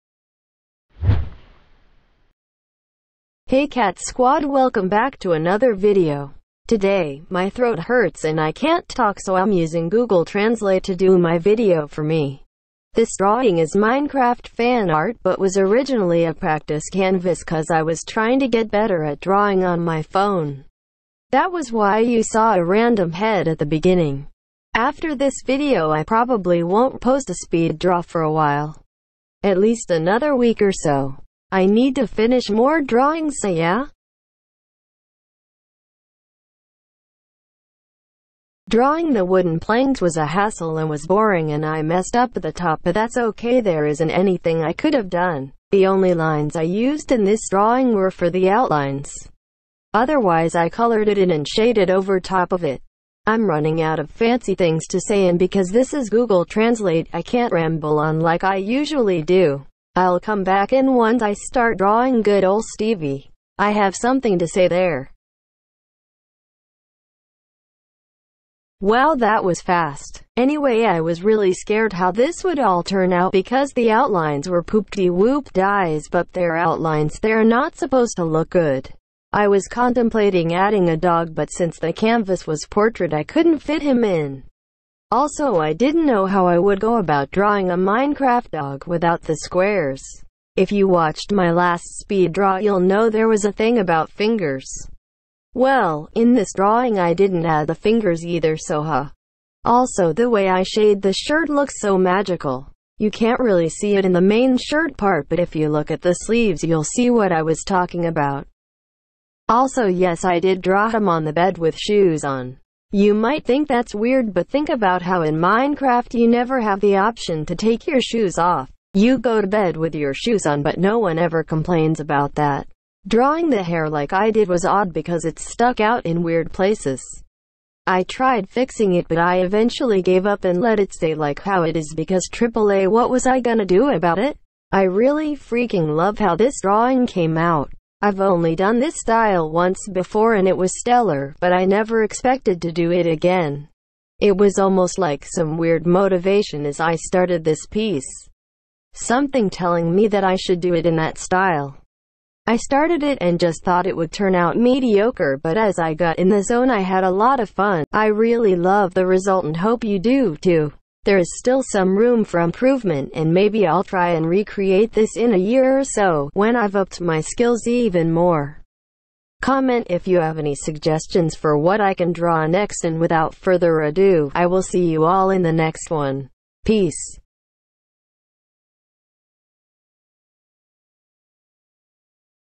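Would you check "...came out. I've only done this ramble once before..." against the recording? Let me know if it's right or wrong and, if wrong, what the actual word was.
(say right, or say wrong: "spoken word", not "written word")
wrong: "style", not "ramble".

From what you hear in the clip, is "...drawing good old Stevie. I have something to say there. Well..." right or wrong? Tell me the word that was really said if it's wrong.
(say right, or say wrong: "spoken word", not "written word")
right.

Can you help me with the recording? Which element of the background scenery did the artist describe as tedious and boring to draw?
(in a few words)
wooden planks.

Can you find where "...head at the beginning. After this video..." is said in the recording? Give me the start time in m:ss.
0:23.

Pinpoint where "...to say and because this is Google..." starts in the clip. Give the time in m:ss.
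0:54.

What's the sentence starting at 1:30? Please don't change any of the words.
If you watched my last speed draw you'll know there was a thing about fingers.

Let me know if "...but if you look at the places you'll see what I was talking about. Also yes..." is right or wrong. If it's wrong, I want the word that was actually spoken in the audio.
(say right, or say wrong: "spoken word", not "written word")
wrong: "sleeves", not "places".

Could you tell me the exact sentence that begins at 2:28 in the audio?
Something telling me that I should do it in that style.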